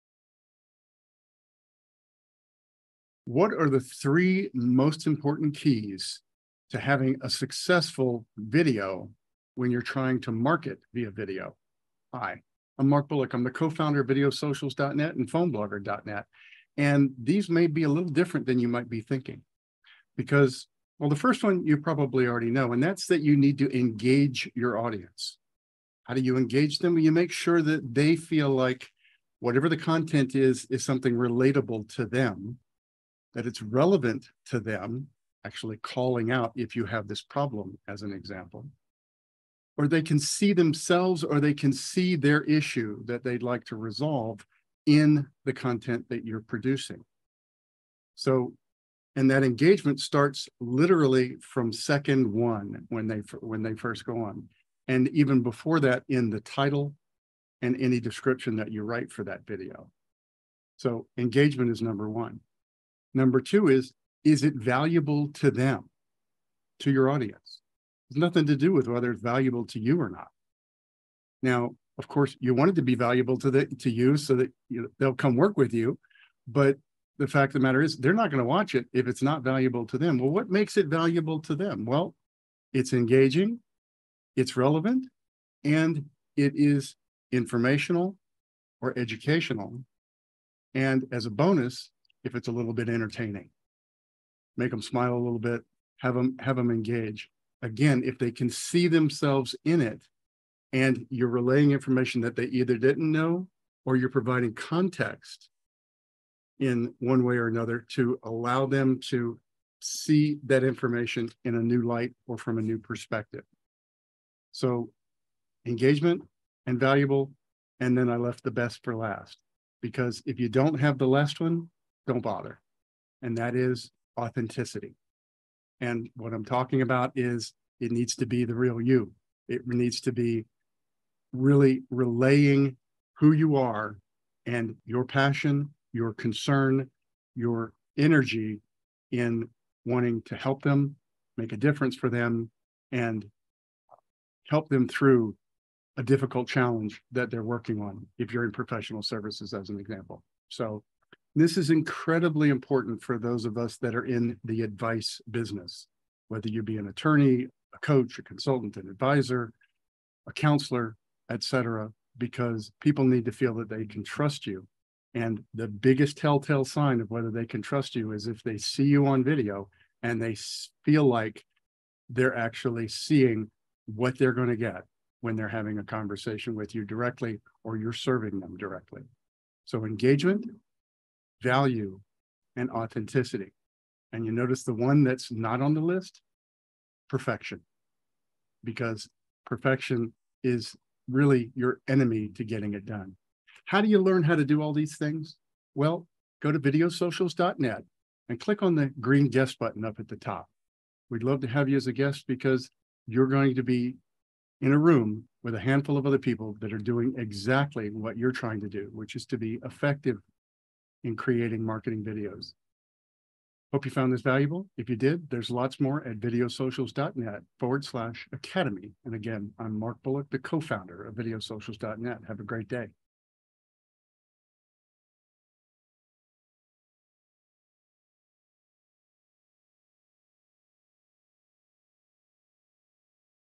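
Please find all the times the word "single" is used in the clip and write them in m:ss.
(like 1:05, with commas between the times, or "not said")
not said.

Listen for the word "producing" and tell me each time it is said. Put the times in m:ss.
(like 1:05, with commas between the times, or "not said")
0:46.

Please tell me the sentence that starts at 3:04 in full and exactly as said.
And you notice the one that's not on the list perfection, because perfection is really your enemy to getting it done.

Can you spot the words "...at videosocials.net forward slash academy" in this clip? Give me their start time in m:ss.
3:36.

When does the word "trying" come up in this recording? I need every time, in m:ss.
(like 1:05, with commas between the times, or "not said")
0:09, 3:28.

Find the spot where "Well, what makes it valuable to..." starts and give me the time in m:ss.
1:20.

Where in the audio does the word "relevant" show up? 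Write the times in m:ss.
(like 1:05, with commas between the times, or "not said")
0:33, 1:24.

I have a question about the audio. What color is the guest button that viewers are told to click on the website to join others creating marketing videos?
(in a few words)
Green.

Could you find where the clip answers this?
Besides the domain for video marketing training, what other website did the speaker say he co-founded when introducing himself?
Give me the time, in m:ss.
0:15.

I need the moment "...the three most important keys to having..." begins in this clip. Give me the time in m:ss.
0:03.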